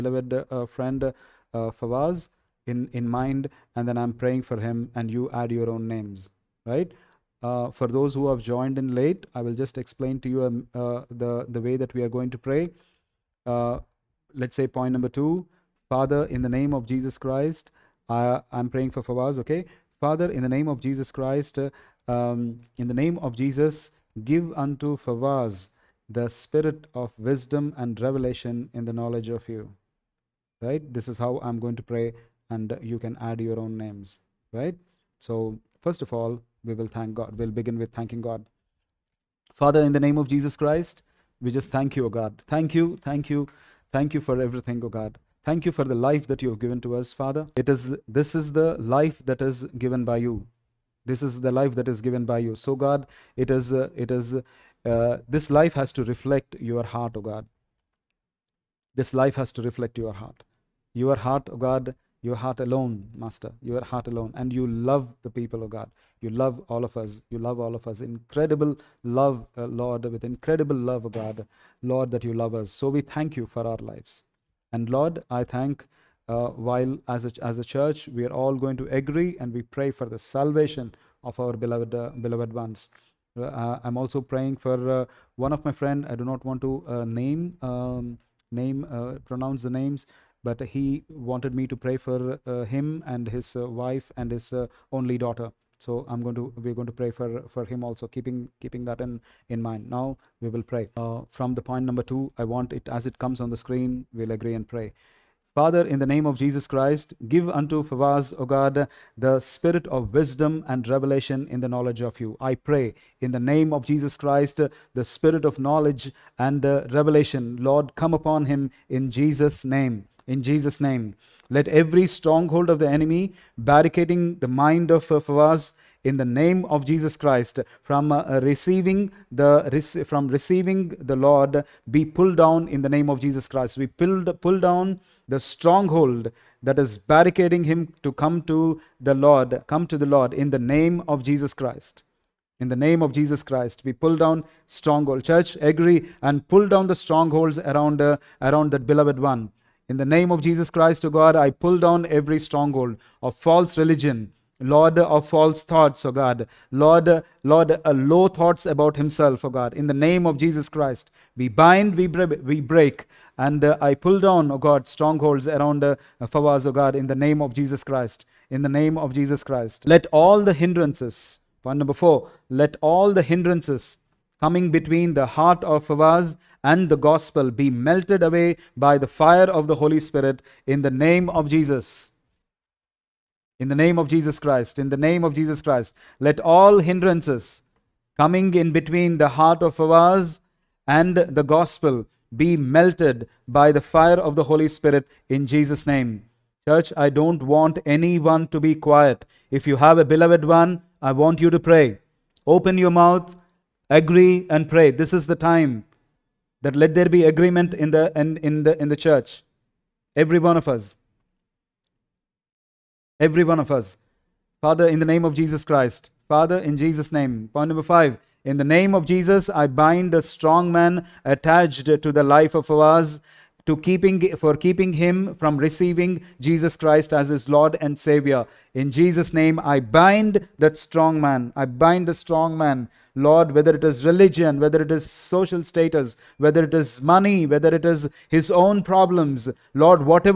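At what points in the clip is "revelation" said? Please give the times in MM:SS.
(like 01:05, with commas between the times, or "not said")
00:28, 01:50, 01:56.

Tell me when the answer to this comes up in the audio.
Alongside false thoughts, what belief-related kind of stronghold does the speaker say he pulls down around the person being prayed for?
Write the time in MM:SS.
02:33.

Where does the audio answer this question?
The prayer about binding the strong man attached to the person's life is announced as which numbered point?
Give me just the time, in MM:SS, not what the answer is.
03:37.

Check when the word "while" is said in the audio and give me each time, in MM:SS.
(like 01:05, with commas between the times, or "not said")
01:16.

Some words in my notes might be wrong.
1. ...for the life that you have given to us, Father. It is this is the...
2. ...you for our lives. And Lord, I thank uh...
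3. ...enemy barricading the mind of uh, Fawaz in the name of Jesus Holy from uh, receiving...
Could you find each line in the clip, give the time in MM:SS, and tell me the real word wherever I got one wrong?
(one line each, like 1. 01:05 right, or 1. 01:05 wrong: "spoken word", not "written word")
1. 00:45 right
2. 01:13 right
3. 02:02 wrong: "Christ", not "Holy".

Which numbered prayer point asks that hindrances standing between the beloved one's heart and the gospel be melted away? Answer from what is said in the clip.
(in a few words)
4.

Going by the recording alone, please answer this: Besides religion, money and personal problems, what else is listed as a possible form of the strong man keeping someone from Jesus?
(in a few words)
social status.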